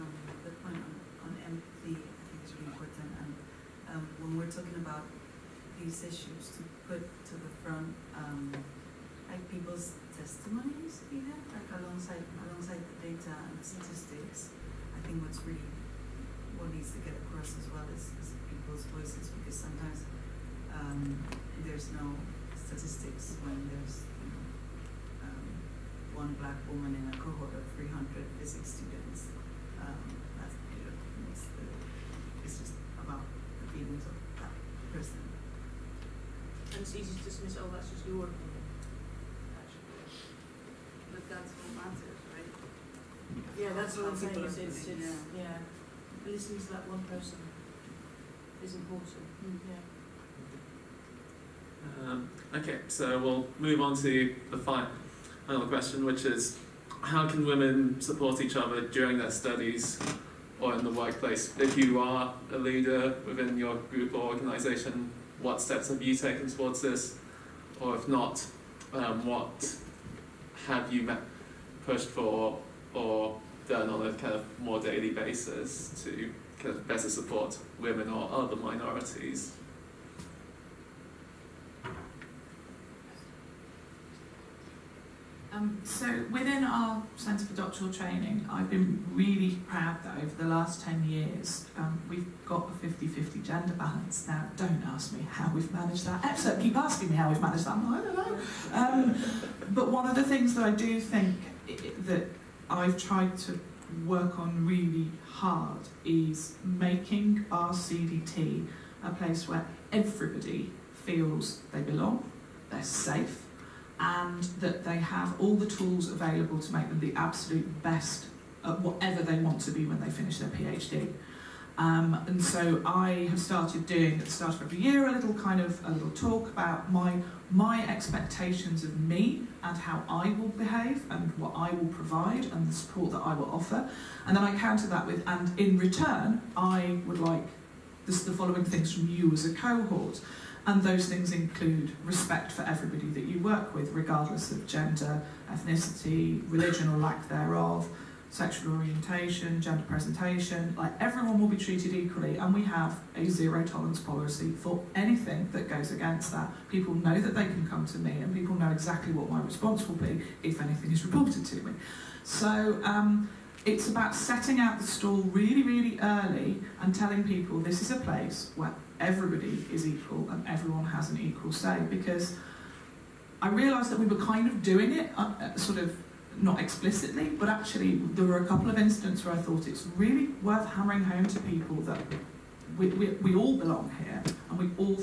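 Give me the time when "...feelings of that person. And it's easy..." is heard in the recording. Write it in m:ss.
0:33.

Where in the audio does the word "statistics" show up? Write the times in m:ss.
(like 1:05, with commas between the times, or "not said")
0:13, 0:22.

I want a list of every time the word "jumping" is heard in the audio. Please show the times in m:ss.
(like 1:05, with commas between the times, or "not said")
not said.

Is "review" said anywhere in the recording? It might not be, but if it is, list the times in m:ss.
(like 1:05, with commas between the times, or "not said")
not said.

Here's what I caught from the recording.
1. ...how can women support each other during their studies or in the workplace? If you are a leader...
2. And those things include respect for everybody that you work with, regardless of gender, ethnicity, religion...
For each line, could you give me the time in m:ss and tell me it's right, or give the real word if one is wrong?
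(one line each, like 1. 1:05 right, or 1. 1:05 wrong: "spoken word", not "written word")
1. 0:57 right
2. 2:20 right.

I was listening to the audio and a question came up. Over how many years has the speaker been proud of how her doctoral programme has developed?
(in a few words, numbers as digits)
10 years.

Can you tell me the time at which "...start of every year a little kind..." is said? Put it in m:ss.
2:04.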